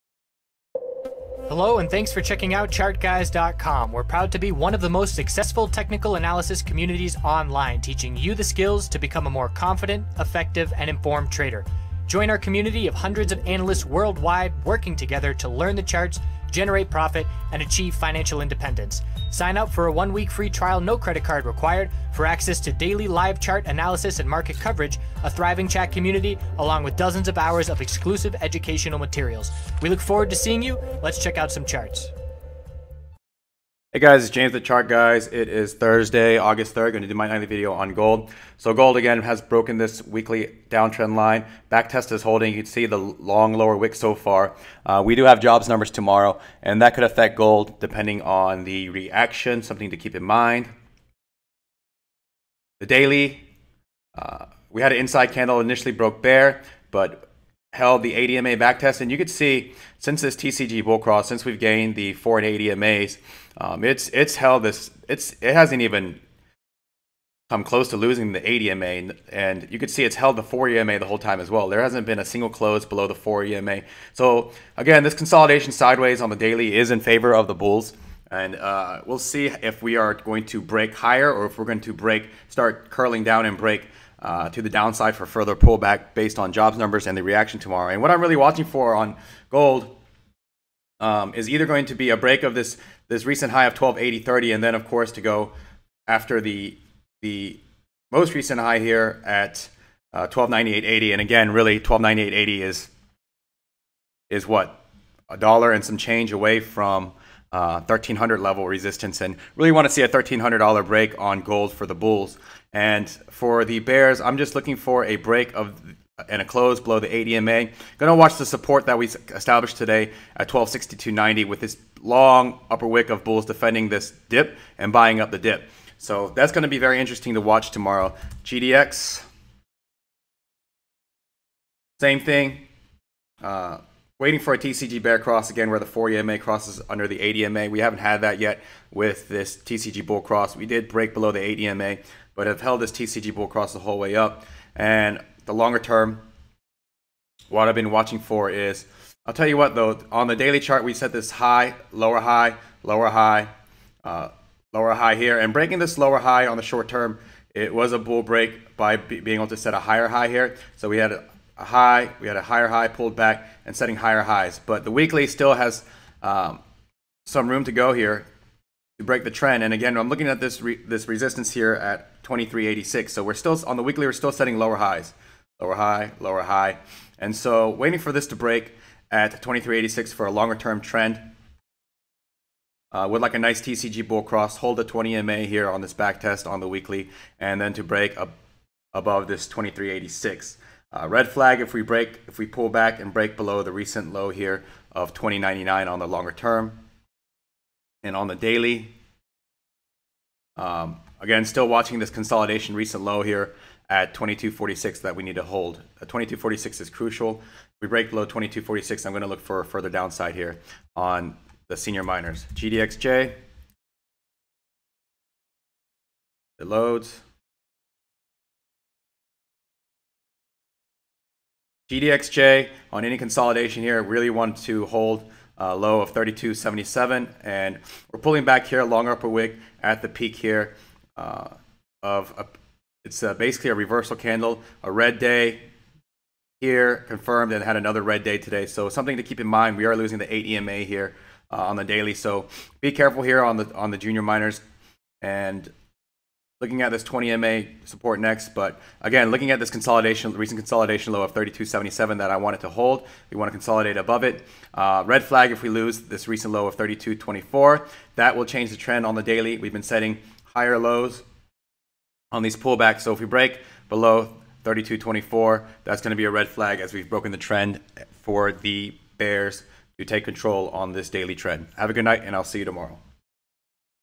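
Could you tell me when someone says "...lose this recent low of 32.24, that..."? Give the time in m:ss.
4:15.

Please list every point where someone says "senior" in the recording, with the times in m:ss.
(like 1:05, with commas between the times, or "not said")
3:31.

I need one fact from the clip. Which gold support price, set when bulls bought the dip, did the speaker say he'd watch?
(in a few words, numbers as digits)
1262.90.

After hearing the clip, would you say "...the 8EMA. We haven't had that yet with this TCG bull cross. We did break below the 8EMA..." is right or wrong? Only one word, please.
right.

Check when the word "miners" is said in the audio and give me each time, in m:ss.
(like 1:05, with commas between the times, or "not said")
3:32, 4:04.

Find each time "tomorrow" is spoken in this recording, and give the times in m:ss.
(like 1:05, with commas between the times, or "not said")
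0:45, 1:27, 2:07, 4:32.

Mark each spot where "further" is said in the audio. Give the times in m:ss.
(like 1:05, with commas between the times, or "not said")
1:25, 3:29.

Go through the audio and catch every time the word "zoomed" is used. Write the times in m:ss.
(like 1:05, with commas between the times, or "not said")
not said.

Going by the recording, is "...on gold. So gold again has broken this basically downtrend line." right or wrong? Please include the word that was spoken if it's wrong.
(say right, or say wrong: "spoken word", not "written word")
wrong: "weekly", not "basically".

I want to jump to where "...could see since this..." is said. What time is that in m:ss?
0:59.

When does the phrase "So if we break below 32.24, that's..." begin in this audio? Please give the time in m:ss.
4:23.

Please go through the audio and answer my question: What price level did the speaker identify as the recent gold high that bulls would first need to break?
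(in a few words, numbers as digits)
1280.30.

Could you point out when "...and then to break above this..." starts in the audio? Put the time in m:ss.
3:07.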